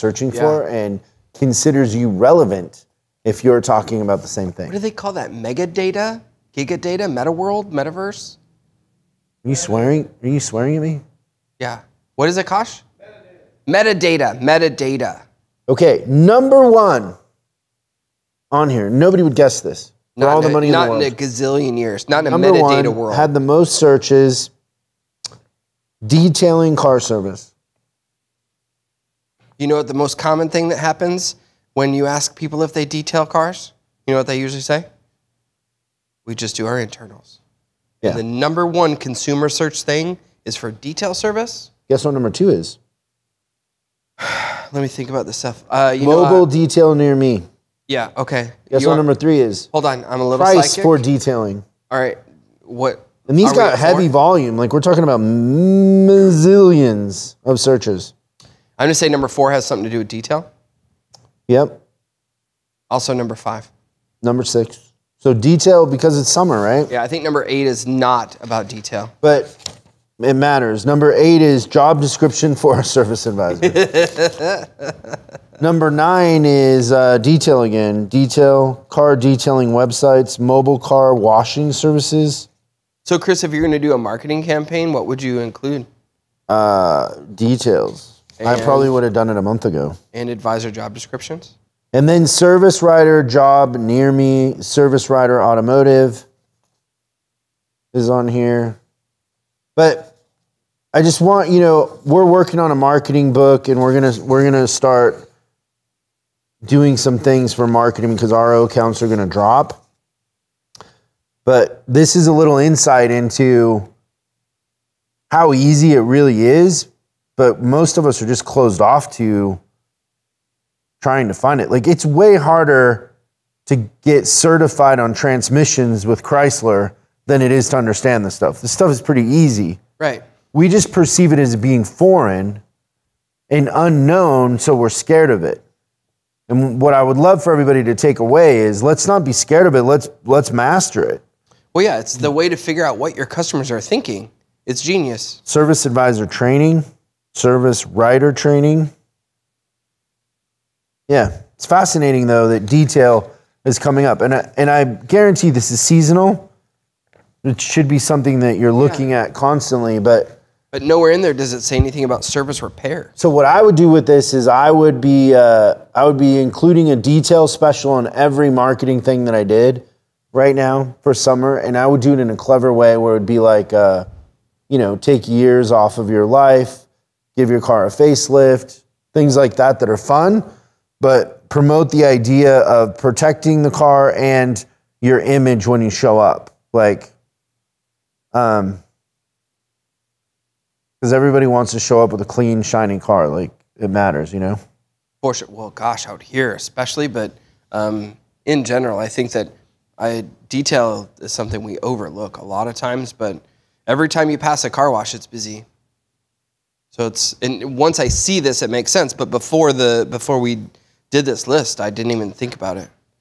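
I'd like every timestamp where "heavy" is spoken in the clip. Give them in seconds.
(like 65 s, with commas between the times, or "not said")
53 s.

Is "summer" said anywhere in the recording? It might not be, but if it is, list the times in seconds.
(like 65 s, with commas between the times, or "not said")
66 s, 171 s.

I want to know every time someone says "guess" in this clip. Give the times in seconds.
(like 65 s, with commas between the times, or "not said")
19 s, 41 s, 48 s.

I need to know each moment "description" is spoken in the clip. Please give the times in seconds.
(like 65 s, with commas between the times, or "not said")
72 s, 90 s.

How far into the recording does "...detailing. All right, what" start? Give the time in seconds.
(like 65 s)
50 s.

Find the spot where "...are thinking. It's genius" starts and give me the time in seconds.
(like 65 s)
143 s.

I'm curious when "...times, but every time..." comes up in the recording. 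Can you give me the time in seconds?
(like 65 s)
202 s.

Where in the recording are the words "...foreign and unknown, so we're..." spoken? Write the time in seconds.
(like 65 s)
131 s.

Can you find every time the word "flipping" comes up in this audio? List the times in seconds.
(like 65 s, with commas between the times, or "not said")
not said.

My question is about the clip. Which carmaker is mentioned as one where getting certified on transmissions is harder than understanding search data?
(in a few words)
Chrysler.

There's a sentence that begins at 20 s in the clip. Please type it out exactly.
Not all the money not in, the in a gazillion years.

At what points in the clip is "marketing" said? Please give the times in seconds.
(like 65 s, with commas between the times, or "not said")
83 s, 102 s, 107 s, 168 s.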